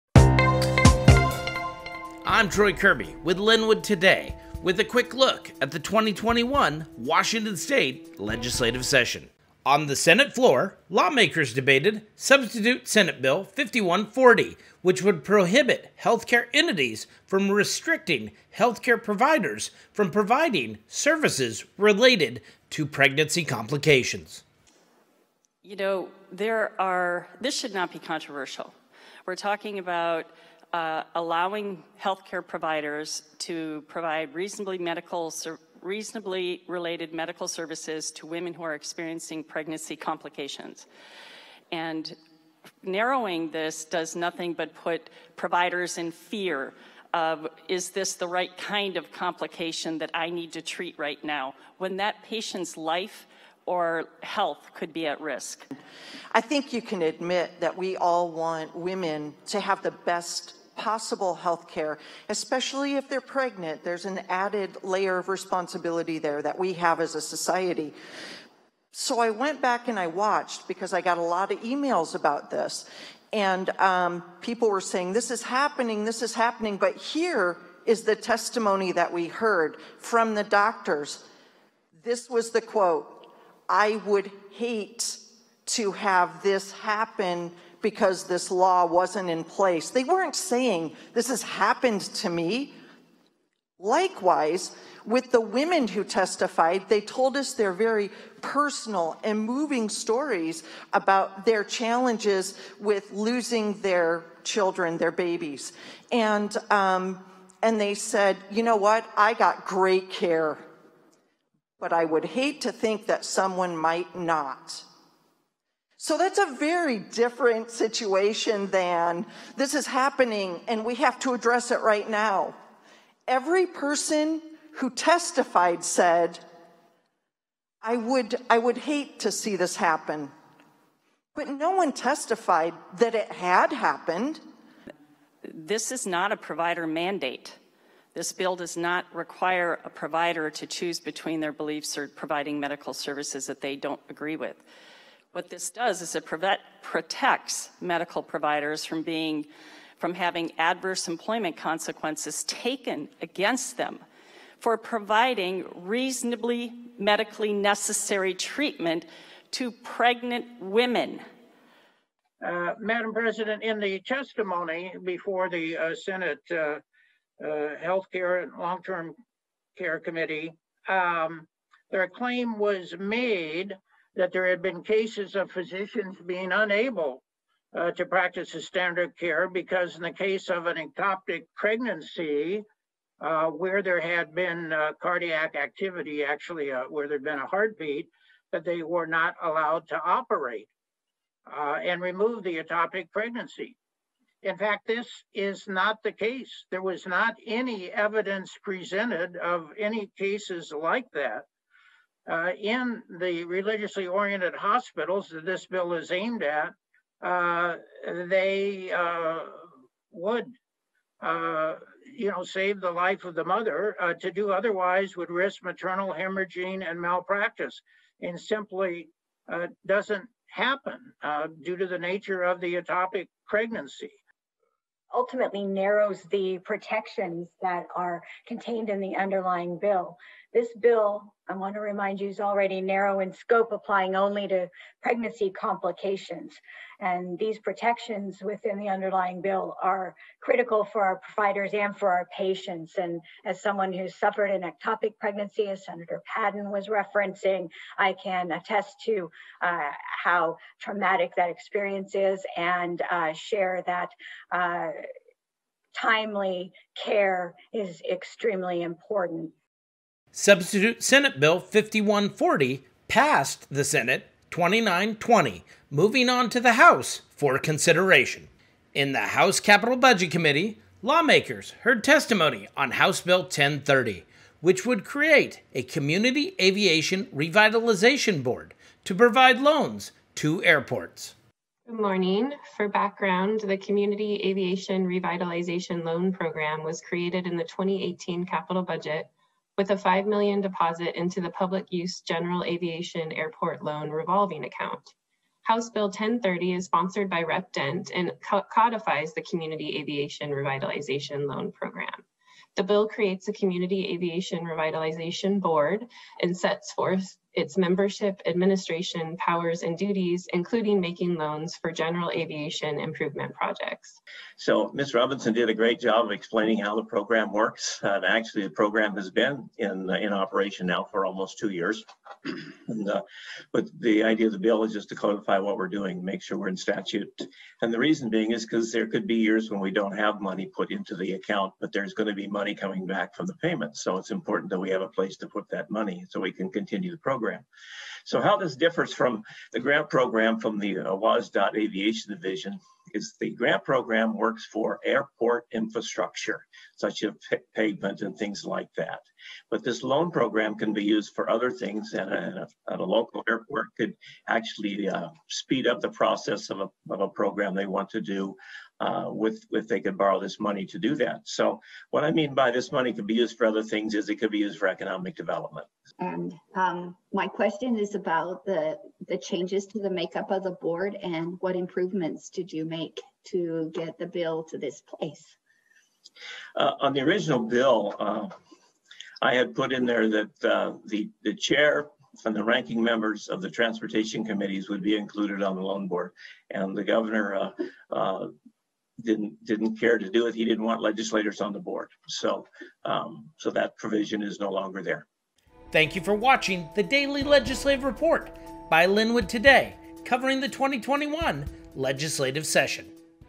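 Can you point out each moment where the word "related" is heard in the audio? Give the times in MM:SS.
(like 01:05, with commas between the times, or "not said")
00:21, 00:36.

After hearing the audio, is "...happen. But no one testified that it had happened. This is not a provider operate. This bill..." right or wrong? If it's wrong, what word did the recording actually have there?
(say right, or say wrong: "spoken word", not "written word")
wrong: "mandate", not "operate".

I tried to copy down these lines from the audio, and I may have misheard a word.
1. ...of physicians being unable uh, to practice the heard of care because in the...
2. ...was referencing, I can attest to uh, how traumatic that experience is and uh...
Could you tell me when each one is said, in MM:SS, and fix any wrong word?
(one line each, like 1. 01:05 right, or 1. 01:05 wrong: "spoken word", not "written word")
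1. 02:55 wrong: "standard", not "heard"
2. 04:06 right.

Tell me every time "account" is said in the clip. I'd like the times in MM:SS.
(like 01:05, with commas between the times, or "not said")
04:54, 05:31.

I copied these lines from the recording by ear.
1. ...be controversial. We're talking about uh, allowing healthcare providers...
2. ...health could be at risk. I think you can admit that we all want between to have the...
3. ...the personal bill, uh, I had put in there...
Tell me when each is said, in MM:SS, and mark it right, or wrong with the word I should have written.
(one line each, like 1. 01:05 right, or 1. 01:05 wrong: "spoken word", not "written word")
1. 00:27 right
2. 00:54 wrong: "women", not "between"
3. 06:17 wrong: "original", not "personal".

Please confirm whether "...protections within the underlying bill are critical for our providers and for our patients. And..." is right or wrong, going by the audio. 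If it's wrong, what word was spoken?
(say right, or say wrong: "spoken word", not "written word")
right.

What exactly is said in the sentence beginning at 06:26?
And the governor uh, uh, didn't didn't care to do it.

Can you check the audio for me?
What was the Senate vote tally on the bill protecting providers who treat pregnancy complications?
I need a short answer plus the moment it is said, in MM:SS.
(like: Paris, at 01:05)
29-20, at 04:24.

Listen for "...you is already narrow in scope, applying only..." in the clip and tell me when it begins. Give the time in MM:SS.
03:52.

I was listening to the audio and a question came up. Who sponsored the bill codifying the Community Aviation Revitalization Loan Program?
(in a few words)
Rep Dent.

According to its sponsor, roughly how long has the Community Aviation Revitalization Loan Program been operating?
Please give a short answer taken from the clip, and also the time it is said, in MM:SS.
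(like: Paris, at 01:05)
almost two years, at 05:21.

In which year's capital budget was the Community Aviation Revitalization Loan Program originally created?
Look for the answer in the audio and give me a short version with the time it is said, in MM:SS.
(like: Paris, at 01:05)
2018, at 04:47.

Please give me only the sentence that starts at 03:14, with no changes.
In fact, this is not the case.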